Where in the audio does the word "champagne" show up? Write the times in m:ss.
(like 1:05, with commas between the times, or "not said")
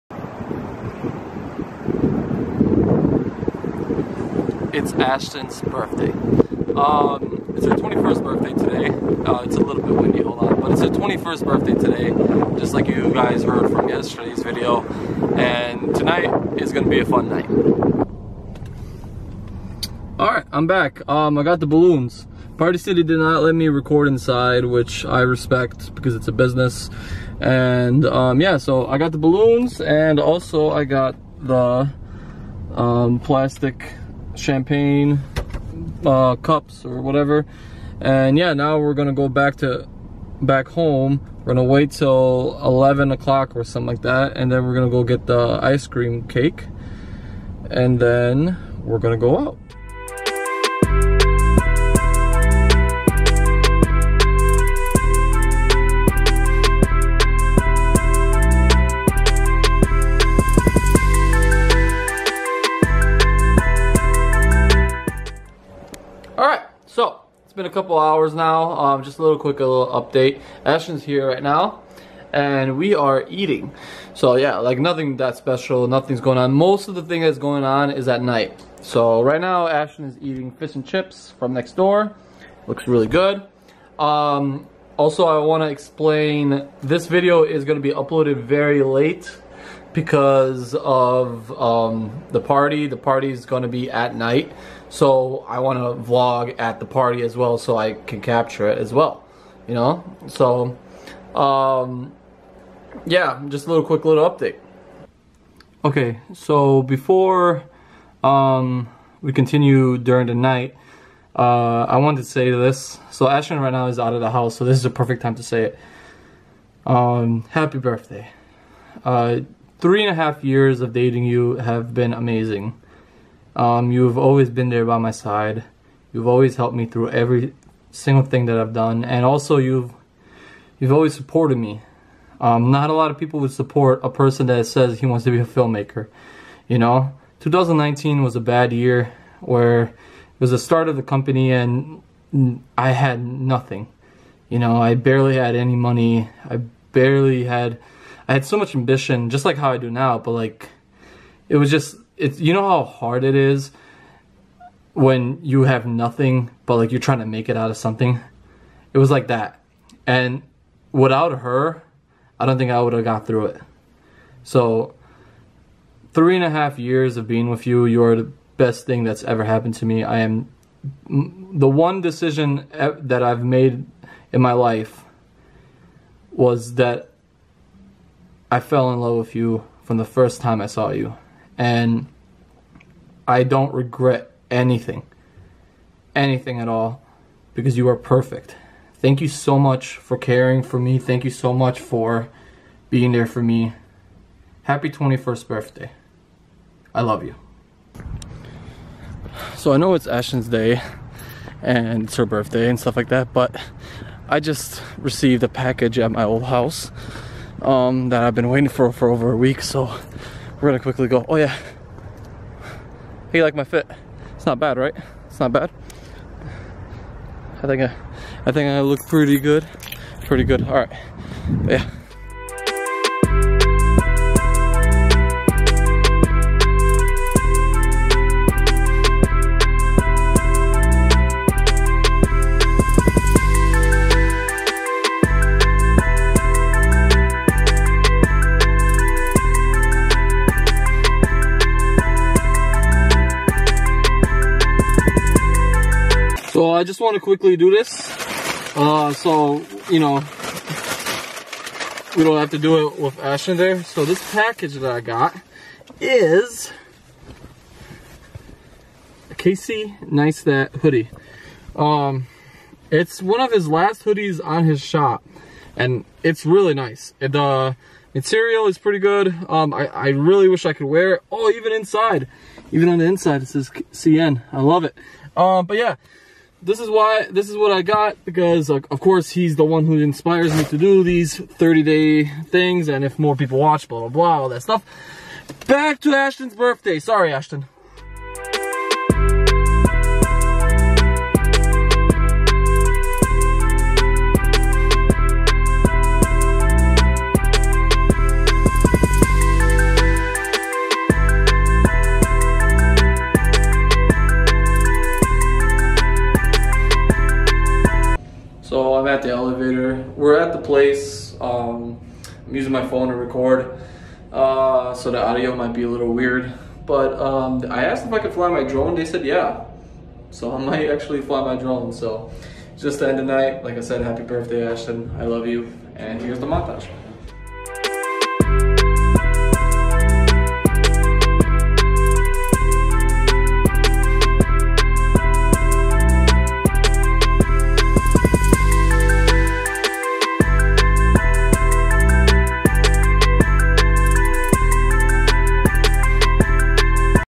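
0:34.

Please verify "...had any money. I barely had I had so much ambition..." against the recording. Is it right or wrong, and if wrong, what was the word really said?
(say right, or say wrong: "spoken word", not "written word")
right.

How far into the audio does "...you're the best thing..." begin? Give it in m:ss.
2:47.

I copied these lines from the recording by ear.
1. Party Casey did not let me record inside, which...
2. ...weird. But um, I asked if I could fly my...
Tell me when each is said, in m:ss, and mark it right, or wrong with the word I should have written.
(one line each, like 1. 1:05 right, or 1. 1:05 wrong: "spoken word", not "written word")
1. 0:22 wrong: "City", not "Casey"
2. 5:16 right.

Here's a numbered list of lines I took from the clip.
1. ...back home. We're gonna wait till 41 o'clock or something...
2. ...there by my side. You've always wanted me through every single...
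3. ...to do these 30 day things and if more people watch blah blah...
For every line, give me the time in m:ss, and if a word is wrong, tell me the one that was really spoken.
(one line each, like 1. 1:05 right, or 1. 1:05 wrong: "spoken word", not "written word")
1. 0:40 wrong: "11", not "41"
2. 2:04 wrong: "helped", not "wanted"
3. 4:40 right.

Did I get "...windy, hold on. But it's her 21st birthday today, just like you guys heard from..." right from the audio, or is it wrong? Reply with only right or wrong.
right.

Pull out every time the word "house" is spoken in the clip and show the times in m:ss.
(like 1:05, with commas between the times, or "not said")
1:54, 3:26.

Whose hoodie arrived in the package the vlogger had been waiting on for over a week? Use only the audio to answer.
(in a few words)
Casey Neistat.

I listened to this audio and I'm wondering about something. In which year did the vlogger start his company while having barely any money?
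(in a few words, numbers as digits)
2019.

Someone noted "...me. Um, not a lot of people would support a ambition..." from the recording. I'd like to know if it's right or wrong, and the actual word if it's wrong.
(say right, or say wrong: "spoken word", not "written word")
wrong: "person", not "ambition".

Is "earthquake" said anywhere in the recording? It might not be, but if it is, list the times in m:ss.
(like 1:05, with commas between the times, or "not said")
not said.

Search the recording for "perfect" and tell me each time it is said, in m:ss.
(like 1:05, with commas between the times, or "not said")
1:54, 3:07.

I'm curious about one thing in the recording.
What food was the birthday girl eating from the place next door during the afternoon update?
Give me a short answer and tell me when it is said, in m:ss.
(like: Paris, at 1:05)
fish and chips, at 1:20.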